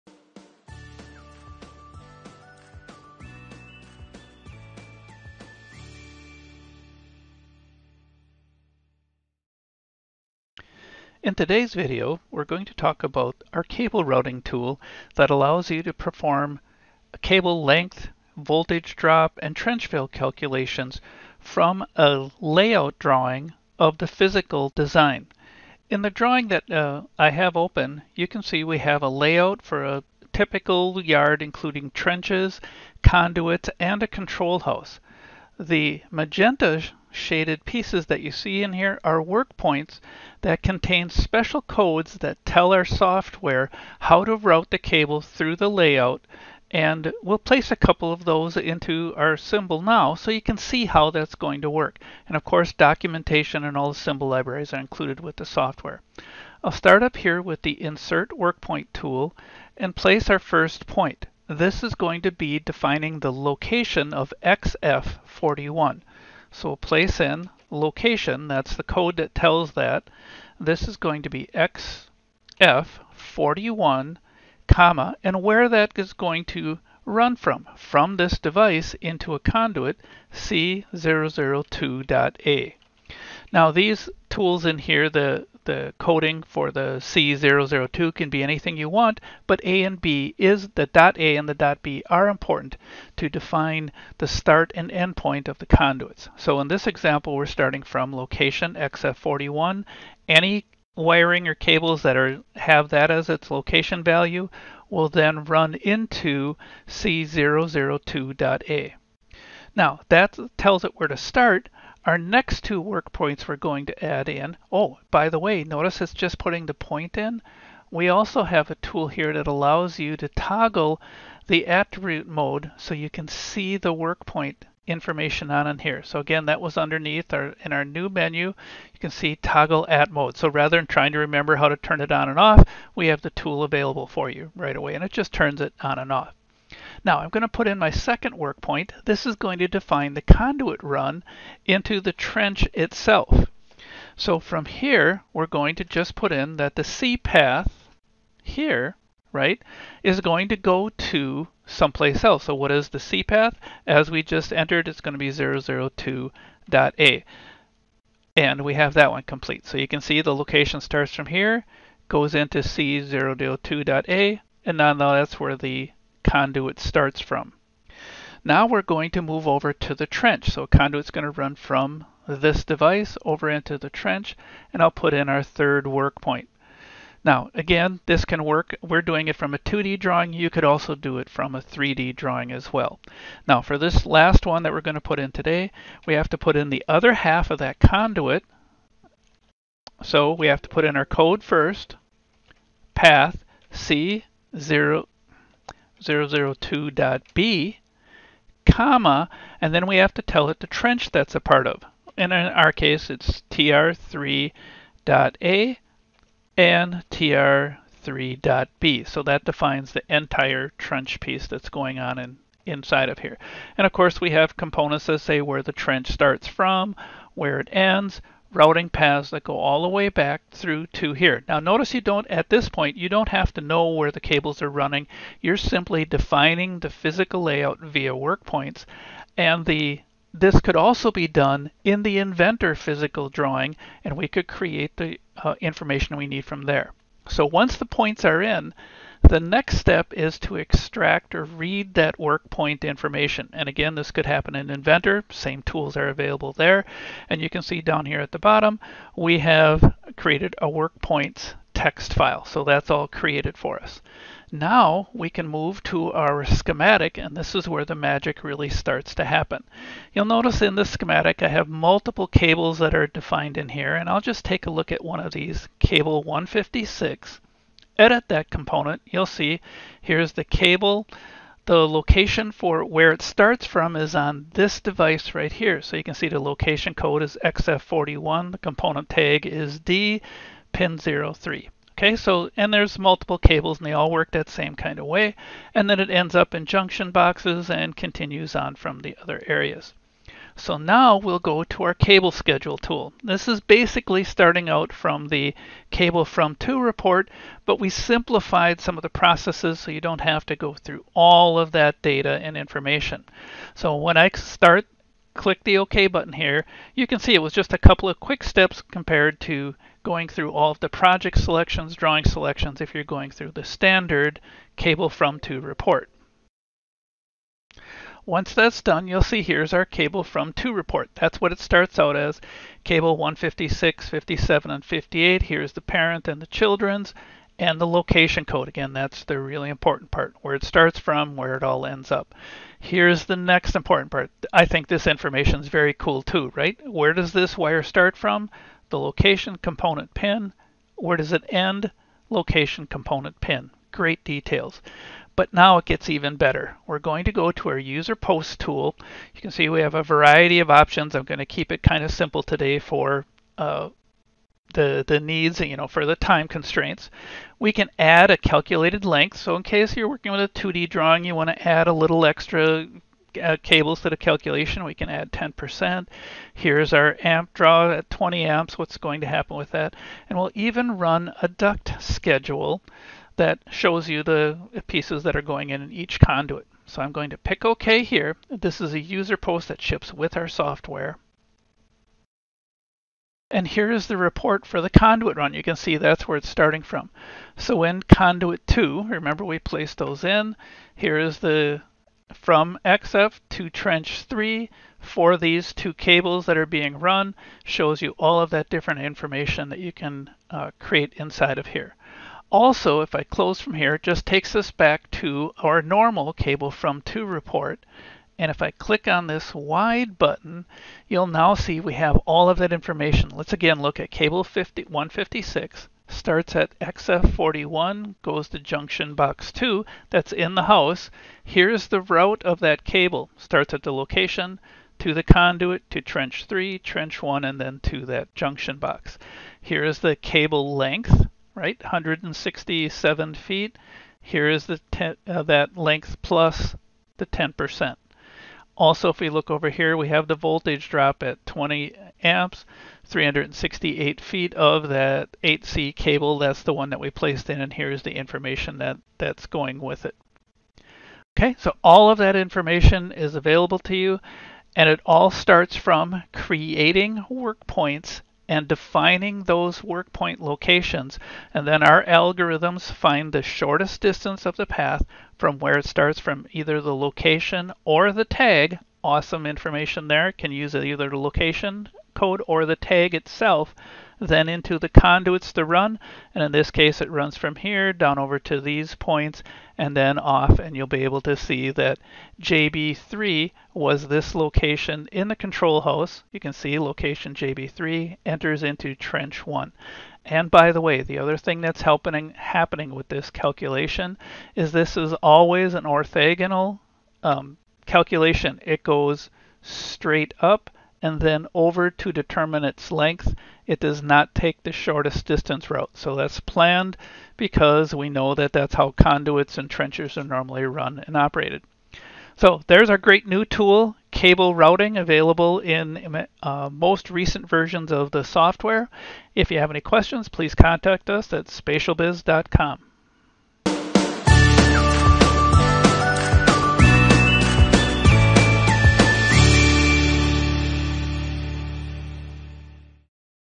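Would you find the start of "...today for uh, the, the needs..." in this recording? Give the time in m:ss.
5:52.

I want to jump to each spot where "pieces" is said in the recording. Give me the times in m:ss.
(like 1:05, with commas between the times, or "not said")
0:37, 3:31, 6:14.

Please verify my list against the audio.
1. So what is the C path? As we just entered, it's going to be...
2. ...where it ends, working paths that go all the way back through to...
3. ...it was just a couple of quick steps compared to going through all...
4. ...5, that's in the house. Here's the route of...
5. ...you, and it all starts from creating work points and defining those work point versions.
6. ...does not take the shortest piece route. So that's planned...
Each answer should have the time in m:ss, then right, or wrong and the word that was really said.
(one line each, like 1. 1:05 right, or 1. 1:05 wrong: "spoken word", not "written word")
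1. 2:32 right
2. 3:37 wrong: "routing", not "working"
3. 5:07 right
4. 6:59 wrong: "2", not "5"
5. 7:33 wrong: "locations", not "versions"
6. 8:23 wrong: "distance", not "piece".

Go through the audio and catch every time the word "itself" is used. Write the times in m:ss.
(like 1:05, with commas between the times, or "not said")
2:22, 7:53.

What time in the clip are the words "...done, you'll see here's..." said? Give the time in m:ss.
5:18.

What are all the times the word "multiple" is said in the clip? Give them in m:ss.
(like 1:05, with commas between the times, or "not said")
4:21, 4:42.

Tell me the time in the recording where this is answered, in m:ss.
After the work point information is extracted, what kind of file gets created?
4:10.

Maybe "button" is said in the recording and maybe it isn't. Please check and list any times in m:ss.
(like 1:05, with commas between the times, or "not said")
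5:06, 6:50.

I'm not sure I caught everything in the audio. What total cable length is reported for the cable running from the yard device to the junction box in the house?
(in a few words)
167 feet.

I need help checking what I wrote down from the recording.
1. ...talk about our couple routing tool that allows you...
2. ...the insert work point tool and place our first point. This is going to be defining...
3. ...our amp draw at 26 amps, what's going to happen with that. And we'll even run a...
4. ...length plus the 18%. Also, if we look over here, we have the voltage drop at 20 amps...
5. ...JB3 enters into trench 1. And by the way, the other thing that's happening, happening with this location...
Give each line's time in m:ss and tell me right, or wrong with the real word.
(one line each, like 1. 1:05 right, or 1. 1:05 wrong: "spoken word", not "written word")
1. 0:12 wrong: "cable", not "couple"
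2. 0:57 right
3. 6:06 wrong: "20", not "26"
4. 7:15 wrong: "10", not "18"
5. 8:07 wrong: "calculation", not "location".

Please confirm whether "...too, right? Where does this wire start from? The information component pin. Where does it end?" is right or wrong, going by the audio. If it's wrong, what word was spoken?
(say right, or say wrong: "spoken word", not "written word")
wrong: "location", not "information".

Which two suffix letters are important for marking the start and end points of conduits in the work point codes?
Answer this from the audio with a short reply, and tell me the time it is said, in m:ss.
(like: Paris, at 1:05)
A and B, at 1:29.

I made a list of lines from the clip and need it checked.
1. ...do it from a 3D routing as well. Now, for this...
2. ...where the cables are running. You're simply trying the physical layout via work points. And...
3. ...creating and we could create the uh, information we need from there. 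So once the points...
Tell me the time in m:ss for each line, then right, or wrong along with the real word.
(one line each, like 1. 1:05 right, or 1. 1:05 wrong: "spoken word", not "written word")
1. 3:00 wrong: "drawing", not "routing"
2. 3:43 wrong: "defining", not "trying"
3. 3:53 wrong: "drawing", not "creating".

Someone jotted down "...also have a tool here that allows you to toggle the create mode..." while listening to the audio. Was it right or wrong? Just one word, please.
wrong.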